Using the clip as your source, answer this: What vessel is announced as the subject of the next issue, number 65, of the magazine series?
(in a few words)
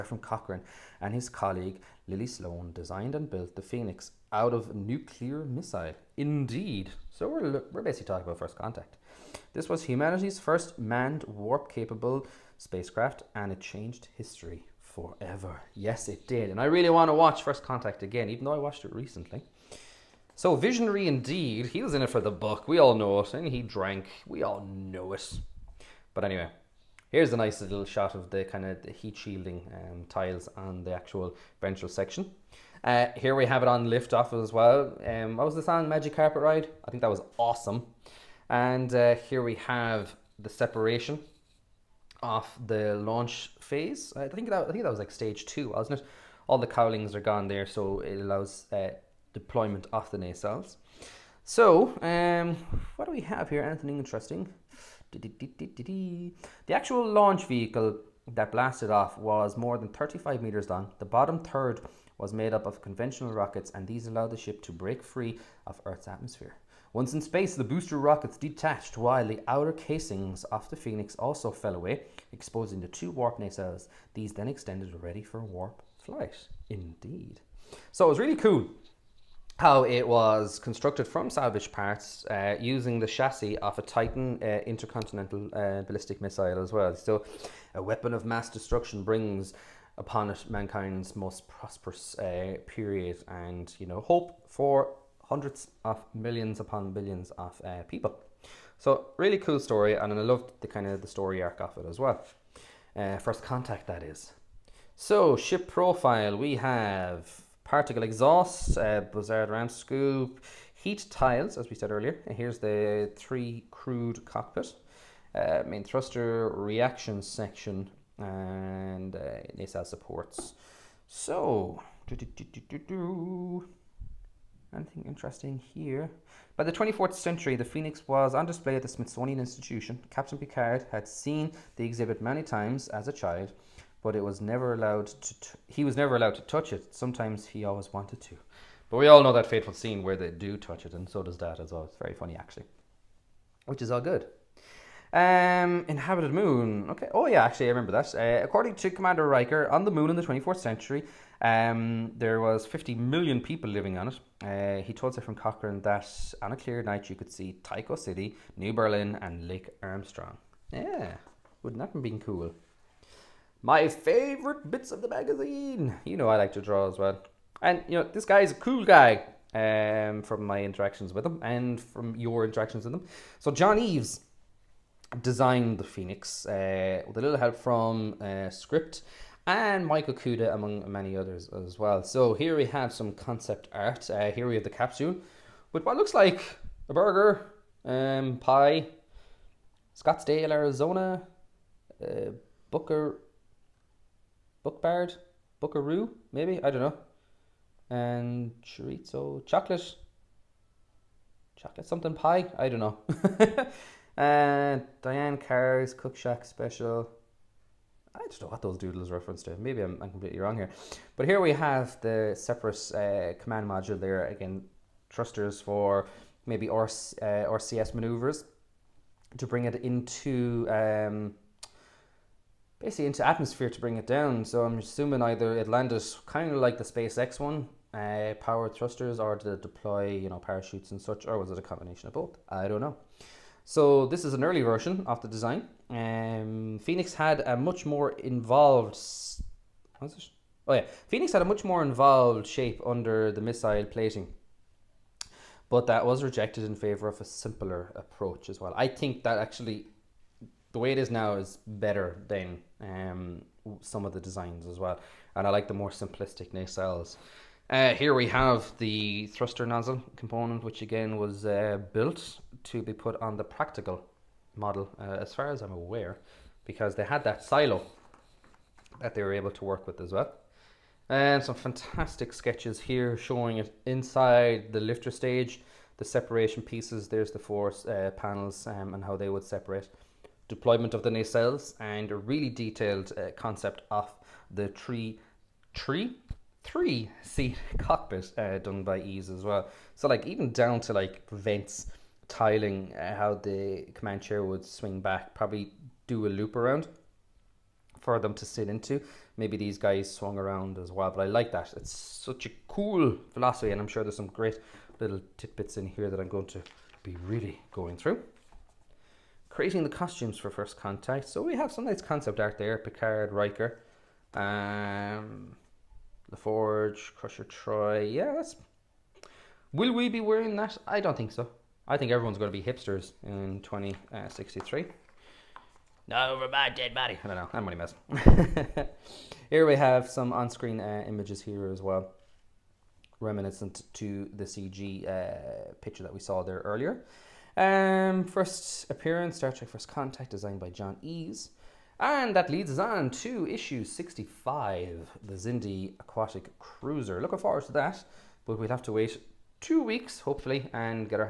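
Xindi Aquatic Cruiser.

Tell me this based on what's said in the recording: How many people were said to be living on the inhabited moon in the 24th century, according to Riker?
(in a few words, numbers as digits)
50 million.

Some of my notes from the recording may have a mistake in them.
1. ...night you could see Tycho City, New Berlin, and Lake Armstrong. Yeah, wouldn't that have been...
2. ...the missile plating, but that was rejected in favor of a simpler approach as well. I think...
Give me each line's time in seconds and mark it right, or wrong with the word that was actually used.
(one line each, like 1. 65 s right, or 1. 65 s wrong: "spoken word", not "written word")
1. 156 s right
2. 243 s right.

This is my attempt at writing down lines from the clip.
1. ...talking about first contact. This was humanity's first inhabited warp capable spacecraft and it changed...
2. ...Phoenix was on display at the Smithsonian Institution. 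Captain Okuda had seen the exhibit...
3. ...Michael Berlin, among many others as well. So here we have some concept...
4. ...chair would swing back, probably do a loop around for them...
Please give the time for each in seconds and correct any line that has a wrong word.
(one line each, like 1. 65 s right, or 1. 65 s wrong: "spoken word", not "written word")
1. 8 s wrong: "manned", not "inhabited"
2. 127 s wrong: "Picard", not "Okuda"
3. 179 s wrong: "Okuda", not "Berlin"
4. 294 s right.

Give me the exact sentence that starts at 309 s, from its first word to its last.
Creating the costumes for First Contact.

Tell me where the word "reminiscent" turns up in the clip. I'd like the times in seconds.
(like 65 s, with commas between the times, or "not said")
333 s.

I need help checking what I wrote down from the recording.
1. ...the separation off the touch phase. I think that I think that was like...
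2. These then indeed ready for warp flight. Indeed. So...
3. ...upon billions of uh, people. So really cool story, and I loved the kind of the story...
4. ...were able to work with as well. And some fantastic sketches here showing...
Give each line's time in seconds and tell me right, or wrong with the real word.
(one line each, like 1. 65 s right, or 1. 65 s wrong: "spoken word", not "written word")
1. 40 s wrong: "launch", not "touch"
2. 74 s wrong: "extended", not "indeed"
3. 96 s right
4. 269 s right.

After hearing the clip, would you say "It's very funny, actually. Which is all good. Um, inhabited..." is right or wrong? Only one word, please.
right.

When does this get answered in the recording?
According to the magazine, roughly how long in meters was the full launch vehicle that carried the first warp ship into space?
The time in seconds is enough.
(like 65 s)
59 s.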